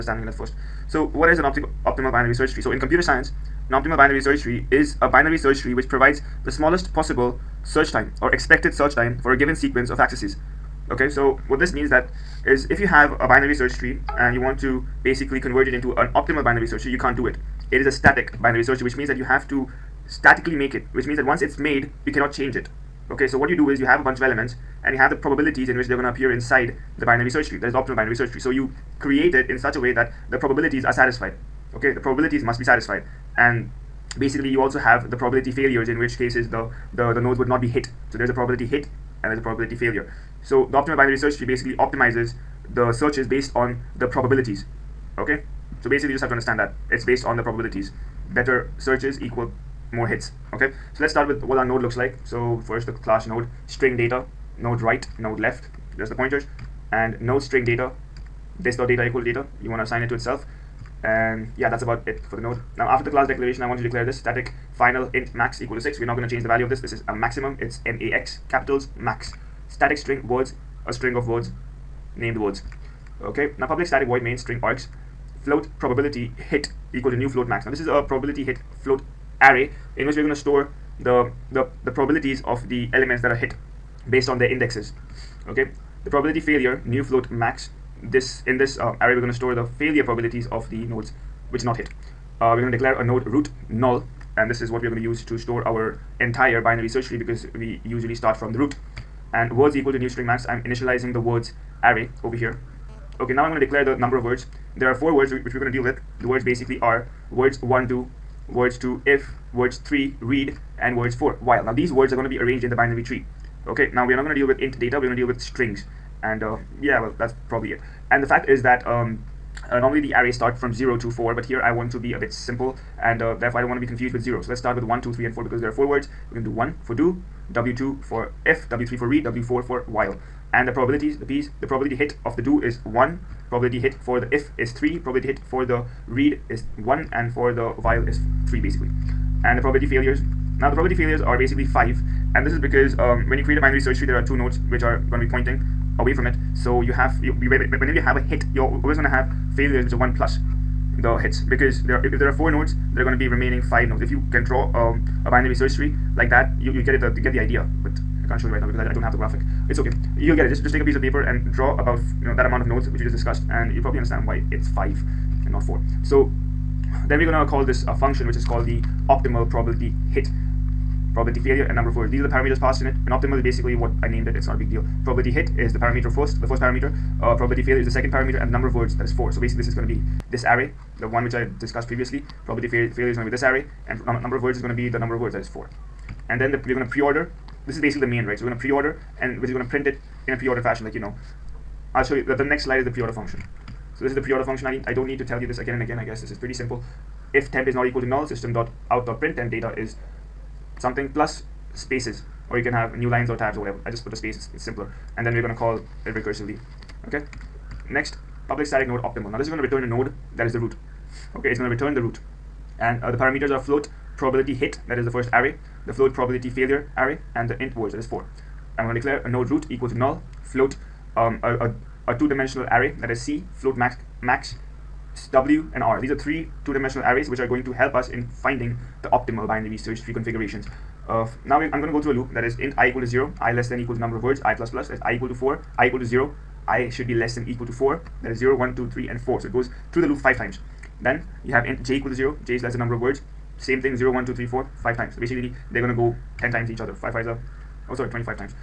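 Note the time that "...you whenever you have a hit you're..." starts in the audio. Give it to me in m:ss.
2:27.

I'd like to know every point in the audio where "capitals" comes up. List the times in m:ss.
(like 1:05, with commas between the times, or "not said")
1:08.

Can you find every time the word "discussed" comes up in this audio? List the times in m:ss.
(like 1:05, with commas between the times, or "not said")
2:43, 3:01.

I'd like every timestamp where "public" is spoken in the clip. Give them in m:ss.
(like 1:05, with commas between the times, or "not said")
1:13, 3:28.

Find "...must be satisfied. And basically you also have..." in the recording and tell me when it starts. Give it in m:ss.
0:32.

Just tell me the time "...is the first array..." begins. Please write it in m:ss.
3:34.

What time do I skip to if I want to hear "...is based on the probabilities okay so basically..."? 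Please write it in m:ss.
0:43.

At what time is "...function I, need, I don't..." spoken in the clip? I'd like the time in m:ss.
3:14.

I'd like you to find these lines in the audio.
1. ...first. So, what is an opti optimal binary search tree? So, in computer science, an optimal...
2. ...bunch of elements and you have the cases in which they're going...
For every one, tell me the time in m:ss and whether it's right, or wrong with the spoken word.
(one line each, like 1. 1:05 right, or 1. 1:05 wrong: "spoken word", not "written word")
1. 0:00 right
2. 0:24 wrong: "probabilities", not "cases".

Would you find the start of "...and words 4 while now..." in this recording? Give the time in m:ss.
1:50.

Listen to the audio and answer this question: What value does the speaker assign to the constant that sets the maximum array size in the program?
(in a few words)
6.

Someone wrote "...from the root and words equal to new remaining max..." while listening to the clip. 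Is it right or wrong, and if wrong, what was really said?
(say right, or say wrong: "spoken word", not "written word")
wrong: "string", not "remaining".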